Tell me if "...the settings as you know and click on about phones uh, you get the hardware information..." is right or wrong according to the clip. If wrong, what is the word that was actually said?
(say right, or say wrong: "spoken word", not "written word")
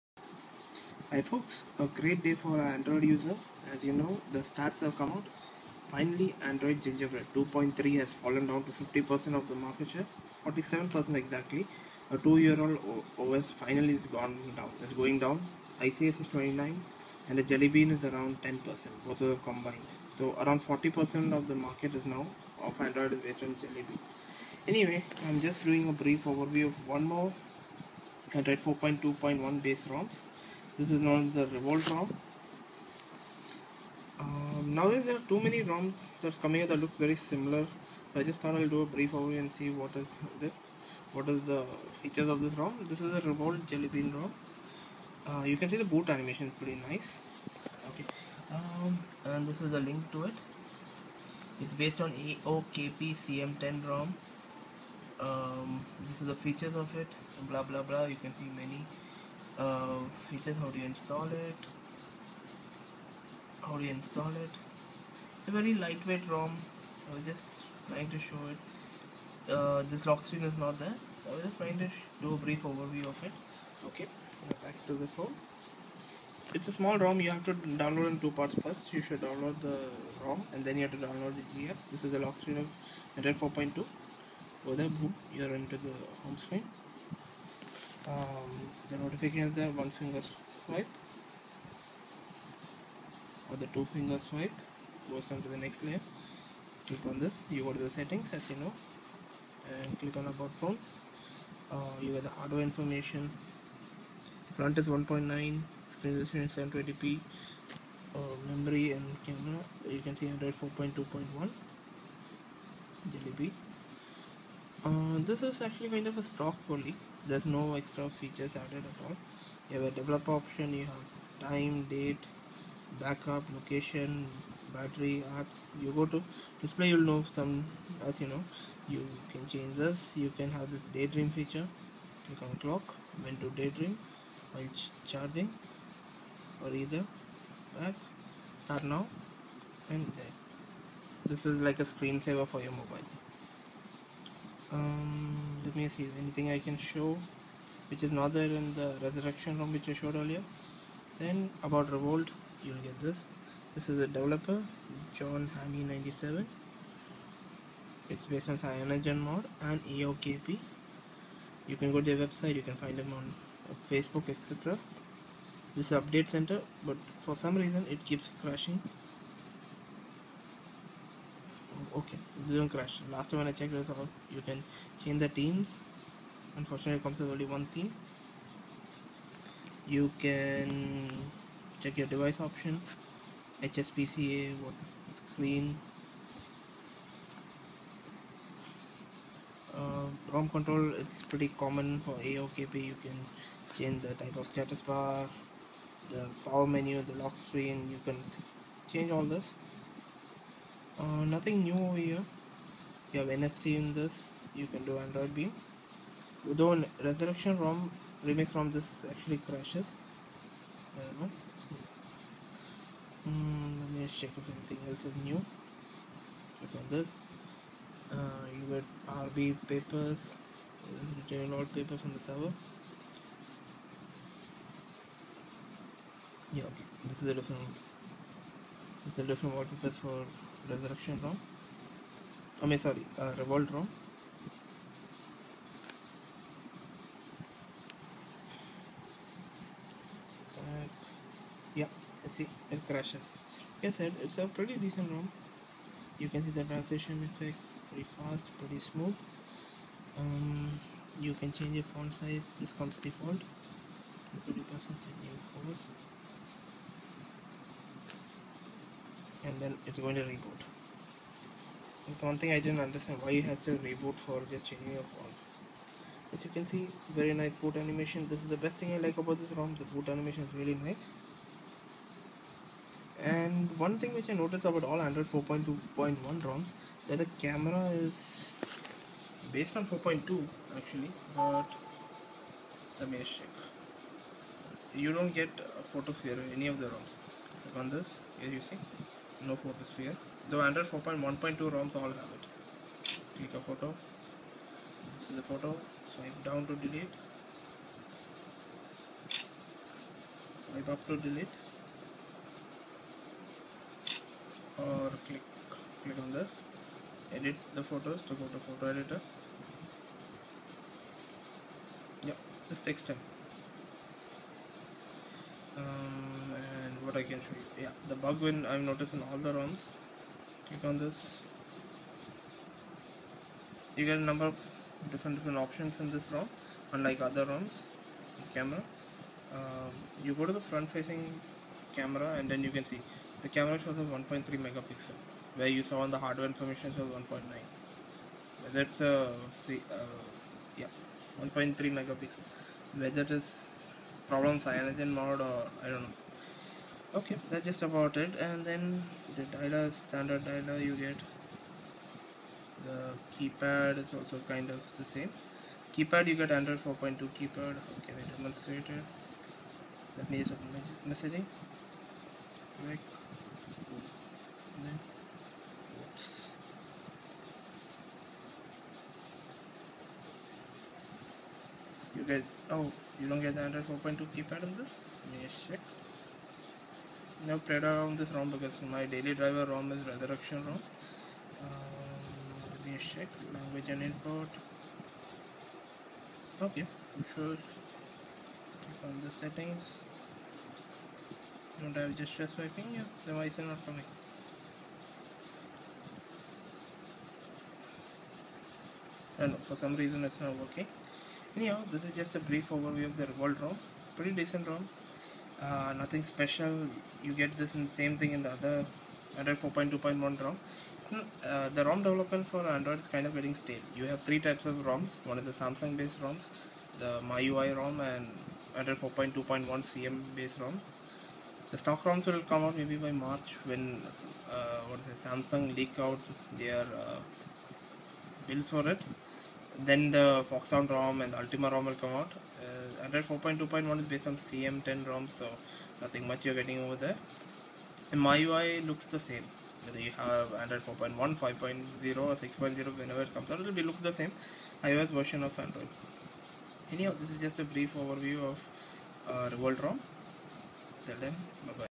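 right.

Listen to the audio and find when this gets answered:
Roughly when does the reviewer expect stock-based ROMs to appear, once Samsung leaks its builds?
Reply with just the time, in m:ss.
7:03.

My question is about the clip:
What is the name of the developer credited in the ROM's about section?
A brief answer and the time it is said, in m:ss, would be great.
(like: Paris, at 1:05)
John Hammy 97, at 2:35.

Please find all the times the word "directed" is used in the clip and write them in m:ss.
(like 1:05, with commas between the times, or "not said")
not said.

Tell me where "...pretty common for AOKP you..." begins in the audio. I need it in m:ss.
3:11.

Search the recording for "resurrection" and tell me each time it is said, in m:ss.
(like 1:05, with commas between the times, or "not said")
2:29, 3:27, 3:50, 6:20.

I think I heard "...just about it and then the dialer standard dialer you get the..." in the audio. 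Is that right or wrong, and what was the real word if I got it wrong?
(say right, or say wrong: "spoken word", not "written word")
right.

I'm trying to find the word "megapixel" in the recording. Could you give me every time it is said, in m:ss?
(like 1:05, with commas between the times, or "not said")
5:34, 5:41.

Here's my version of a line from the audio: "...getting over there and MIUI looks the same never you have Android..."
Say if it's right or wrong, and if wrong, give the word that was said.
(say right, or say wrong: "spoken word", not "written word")
wrong: "whether", not "never".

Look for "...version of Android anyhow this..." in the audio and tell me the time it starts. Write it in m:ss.
7:25.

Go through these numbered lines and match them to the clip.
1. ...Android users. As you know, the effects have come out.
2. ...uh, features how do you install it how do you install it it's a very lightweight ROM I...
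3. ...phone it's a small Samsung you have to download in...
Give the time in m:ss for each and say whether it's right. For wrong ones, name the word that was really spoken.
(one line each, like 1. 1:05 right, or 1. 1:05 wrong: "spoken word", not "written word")
1. 0:02 wrong: "stats", not "effects"
2. 0:59 right
3. 1:15 wrong: "ROM", not "Samsung".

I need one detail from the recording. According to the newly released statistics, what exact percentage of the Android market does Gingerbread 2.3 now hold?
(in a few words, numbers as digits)
47%.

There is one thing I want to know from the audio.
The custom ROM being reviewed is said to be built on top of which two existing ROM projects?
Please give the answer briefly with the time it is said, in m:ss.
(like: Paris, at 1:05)
AOKP CM10, at 0:52.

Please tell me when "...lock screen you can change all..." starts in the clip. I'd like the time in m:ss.
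3:17.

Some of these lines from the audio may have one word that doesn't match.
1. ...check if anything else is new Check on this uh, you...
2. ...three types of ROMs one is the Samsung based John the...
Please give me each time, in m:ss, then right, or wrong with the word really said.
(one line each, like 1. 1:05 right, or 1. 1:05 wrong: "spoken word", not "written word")
1. 3:34 right
2. 6:54 wrong: "ROMs", not "John".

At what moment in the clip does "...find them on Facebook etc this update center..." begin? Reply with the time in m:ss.
2:42.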